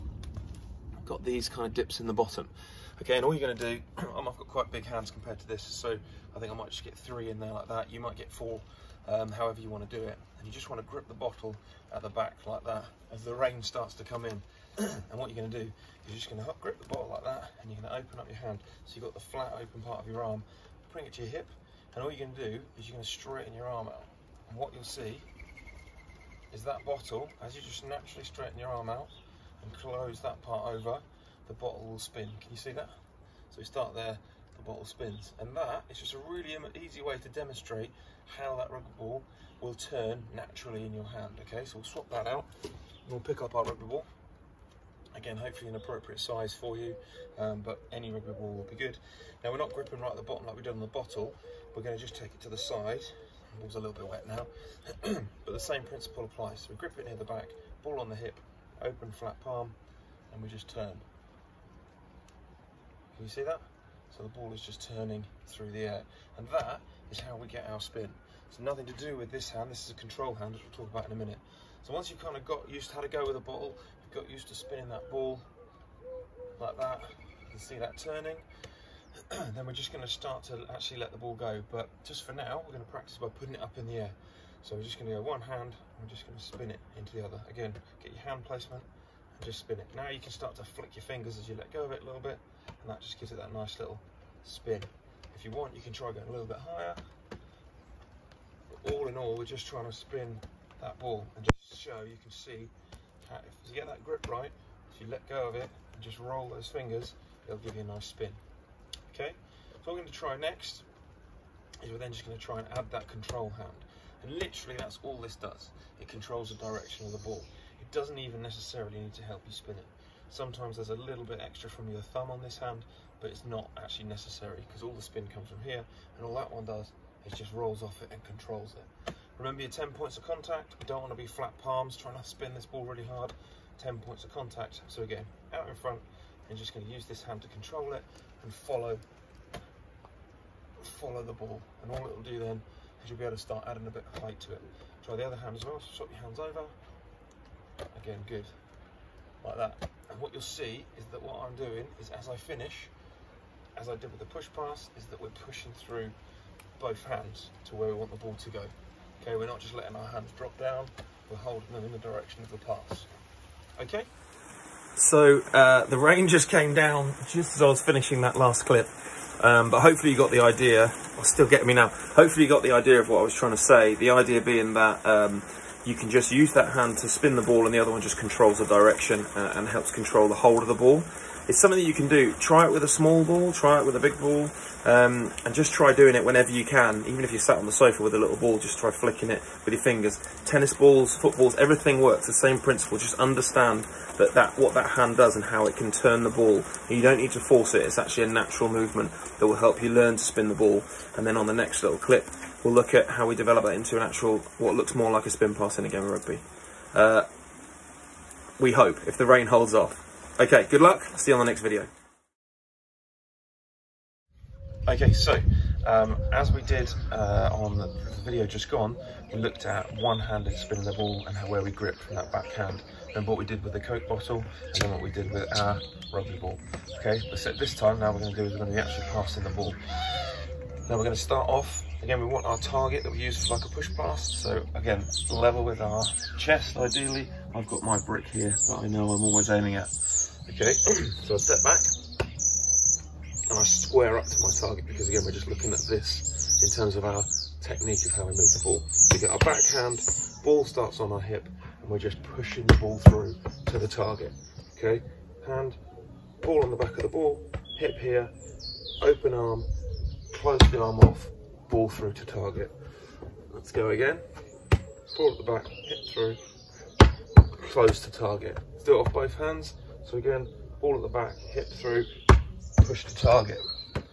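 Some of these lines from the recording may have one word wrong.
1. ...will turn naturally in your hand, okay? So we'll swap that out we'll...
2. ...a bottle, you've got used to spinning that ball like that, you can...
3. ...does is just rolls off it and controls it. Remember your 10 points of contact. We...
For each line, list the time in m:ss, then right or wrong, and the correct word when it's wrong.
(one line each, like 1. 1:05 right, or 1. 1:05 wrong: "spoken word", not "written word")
1. 0:39 right
2. 1:13 right
3. 2:06 right.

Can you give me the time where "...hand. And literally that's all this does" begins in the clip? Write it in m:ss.
1:53.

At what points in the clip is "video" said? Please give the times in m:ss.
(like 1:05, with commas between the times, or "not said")
3:31, 3:38.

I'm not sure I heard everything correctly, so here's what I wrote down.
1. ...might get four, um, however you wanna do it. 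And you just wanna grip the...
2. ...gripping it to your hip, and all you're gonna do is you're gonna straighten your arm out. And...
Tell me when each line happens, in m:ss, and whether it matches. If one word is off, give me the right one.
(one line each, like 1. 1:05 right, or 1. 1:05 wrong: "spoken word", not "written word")
1. 0:07 right
2. 0:20 wrong: "bring", not "gripping".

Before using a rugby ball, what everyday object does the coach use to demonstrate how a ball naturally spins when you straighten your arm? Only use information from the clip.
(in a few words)
Coke bottle.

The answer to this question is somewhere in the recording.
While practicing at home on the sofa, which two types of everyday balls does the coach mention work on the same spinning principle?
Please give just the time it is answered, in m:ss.
3:10.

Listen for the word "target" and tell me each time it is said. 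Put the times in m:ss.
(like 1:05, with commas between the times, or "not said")
3:52, 4:04, 4:13, 4:22, 4:28, 4:33.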